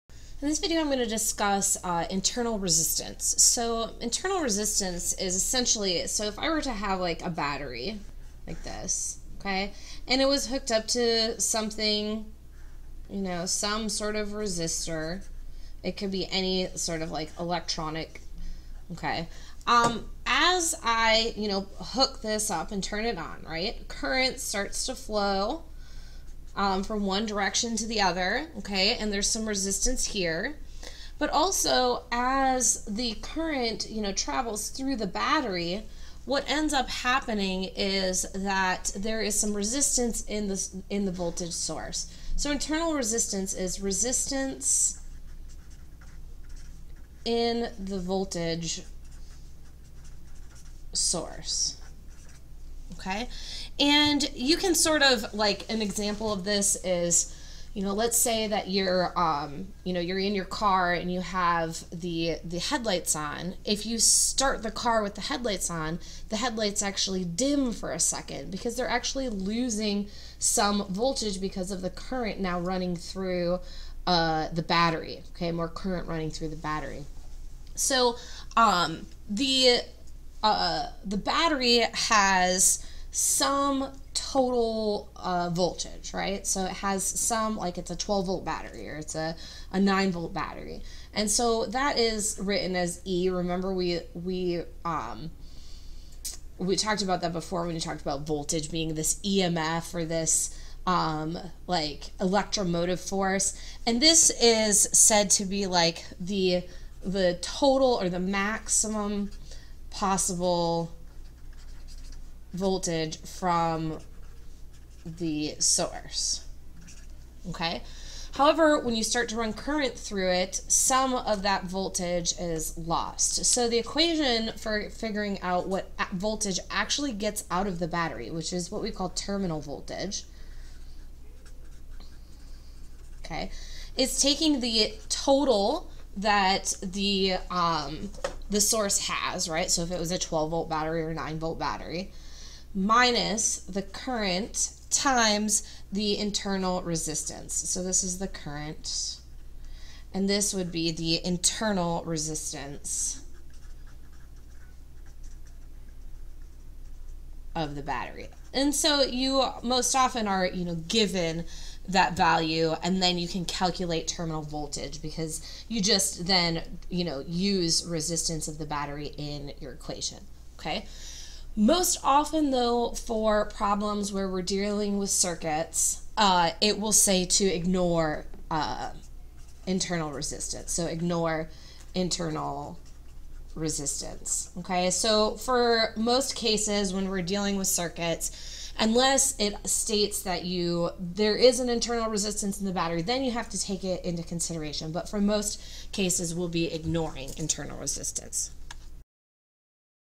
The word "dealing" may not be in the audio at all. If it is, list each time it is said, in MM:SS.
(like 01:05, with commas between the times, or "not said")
02:54, 03:07.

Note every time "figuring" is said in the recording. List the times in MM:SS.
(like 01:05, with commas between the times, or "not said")
02:04.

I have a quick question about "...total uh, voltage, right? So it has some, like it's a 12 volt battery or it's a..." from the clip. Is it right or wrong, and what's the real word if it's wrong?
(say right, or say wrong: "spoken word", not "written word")
right.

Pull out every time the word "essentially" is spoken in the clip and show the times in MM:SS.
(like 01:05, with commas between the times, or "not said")
00:05.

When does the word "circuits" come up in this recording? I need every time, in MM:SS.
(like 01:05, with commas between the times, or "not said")
02:55, 03:07.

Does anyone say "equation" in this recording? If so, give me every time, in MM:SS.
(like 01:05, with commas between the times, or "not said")
02:03, 02:49.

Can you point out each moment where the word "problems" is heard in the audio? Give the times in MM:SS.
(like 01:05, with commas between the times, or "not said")
02:53.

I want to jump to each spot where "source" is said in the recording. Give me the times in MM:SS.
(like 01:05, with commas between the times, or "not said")
00:41, 00:50, 01:55, 02:18.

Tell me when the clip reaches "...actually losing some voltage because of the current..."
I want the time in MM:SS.
01:08.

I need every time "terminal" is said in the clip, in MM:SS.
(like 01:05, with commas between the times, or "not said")
02:09, 02:44.